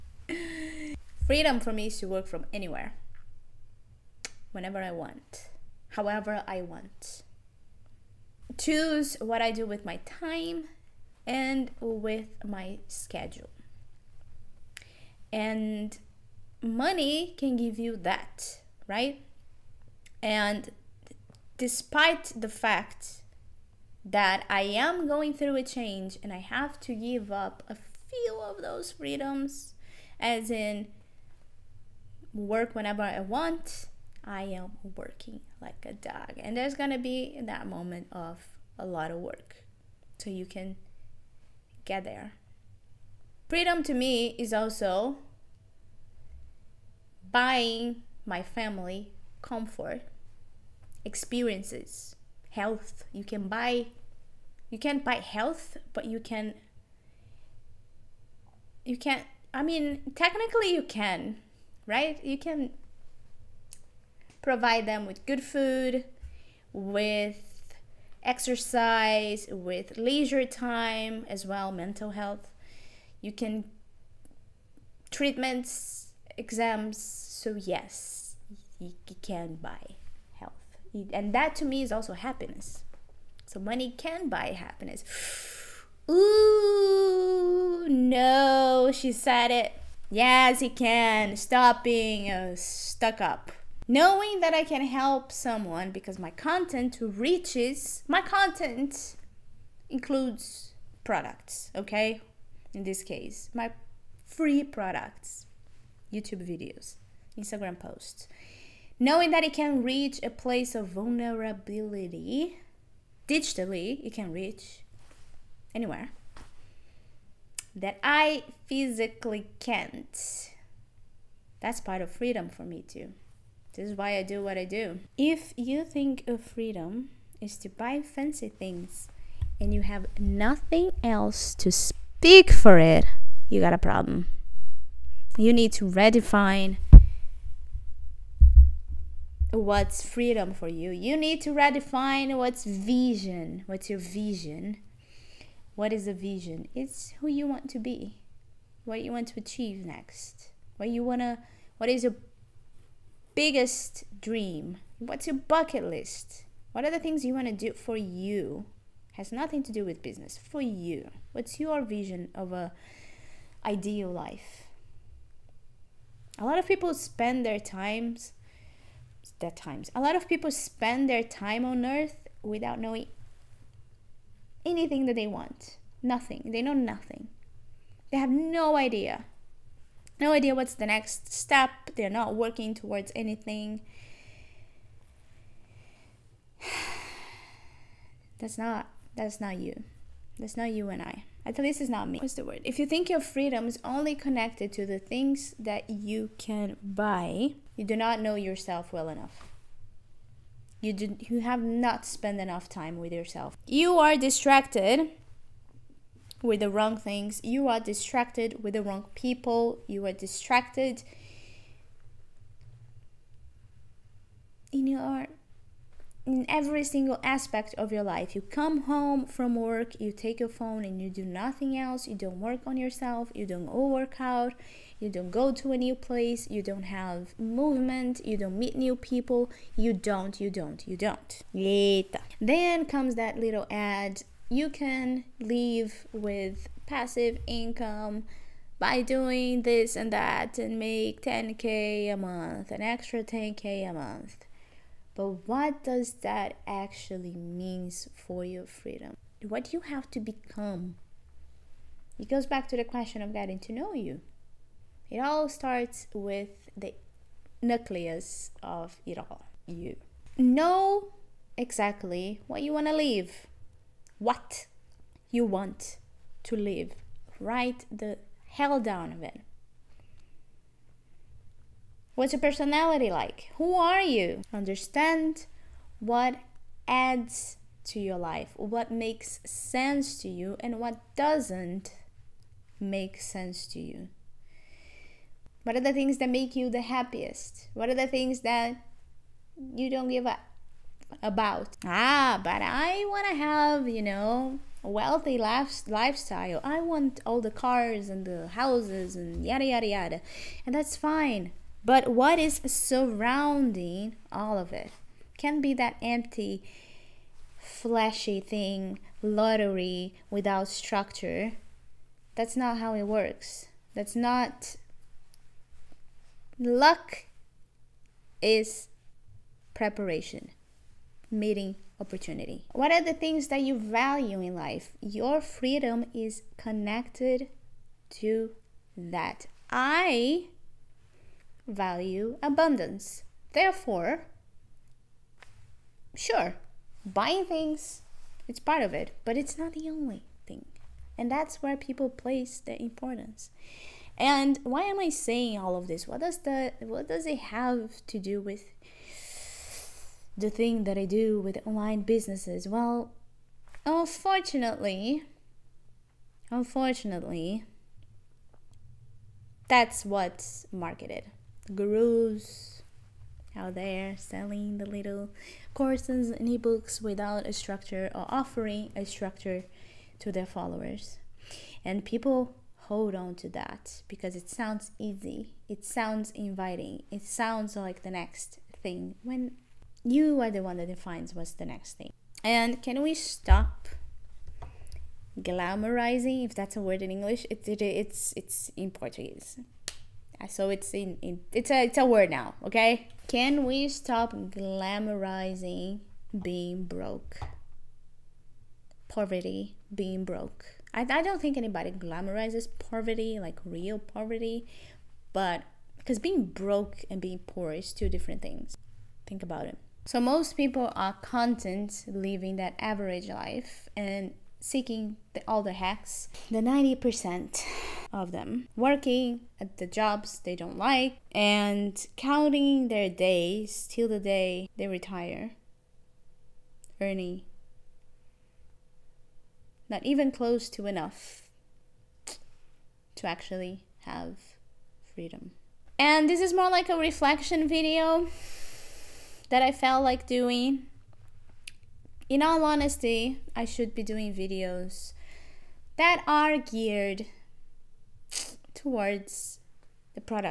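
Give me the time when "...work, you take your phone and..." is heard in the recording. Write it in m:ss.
3:39.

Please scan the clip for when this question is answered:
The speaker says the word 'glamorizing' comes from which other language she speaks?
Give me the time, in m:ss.
6:28.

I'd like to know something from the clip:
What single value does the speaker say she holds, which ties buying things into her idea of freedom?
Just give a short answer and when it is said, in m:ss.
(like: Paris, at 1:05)
Abundance, at 5:32.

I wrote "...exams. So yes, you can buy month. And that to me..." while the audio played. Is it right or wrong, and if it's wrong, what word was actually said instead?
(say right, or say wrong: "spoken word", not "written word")
wrong: "health", not "month".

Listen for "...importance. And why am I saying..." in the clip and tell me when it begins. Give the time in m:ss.
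5:42.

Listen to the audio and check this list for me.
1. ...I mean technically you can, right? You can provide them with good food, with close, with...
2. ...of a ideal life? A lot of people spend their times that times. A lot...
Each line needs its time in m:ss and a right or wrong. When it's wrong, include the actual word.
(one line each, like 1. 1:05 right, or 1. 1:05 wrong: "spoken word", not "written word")
1. 0:59 wrong: "exercise", not "close"
2. 2:42 right.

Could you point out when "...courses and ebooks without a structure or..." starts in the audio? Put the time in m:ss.
6:05.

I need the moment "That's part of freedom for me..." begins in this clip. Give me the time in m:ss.
2:01.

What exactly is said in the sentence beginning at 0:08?
Choose what I do with my time and with my schedule.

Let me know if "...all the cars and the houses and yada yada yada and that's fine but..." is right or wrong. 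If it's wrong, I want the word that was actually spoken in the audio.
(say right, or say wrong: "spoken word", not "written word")
right.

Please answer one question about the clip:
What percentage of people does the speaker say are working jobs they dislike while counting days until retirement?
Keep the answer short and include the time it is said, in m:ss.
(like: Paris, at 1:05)
90%, at 6:56.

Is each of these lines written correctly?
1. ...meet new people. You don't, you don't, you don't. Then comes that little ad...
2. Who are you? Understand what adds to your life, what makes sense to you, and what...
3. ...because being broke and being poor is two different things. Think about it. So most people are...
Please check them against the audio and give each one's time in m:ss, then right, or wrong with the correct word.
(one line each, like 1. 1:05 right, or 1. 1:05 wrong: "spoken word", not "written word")
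1. 3:48 right
2. 4:33 right
3. 6:45 right.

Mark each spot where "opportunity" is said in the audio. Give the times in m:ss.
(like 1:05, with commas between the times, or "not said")
5:21.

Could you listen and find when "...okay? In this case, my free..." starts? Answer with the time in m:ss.
1:41.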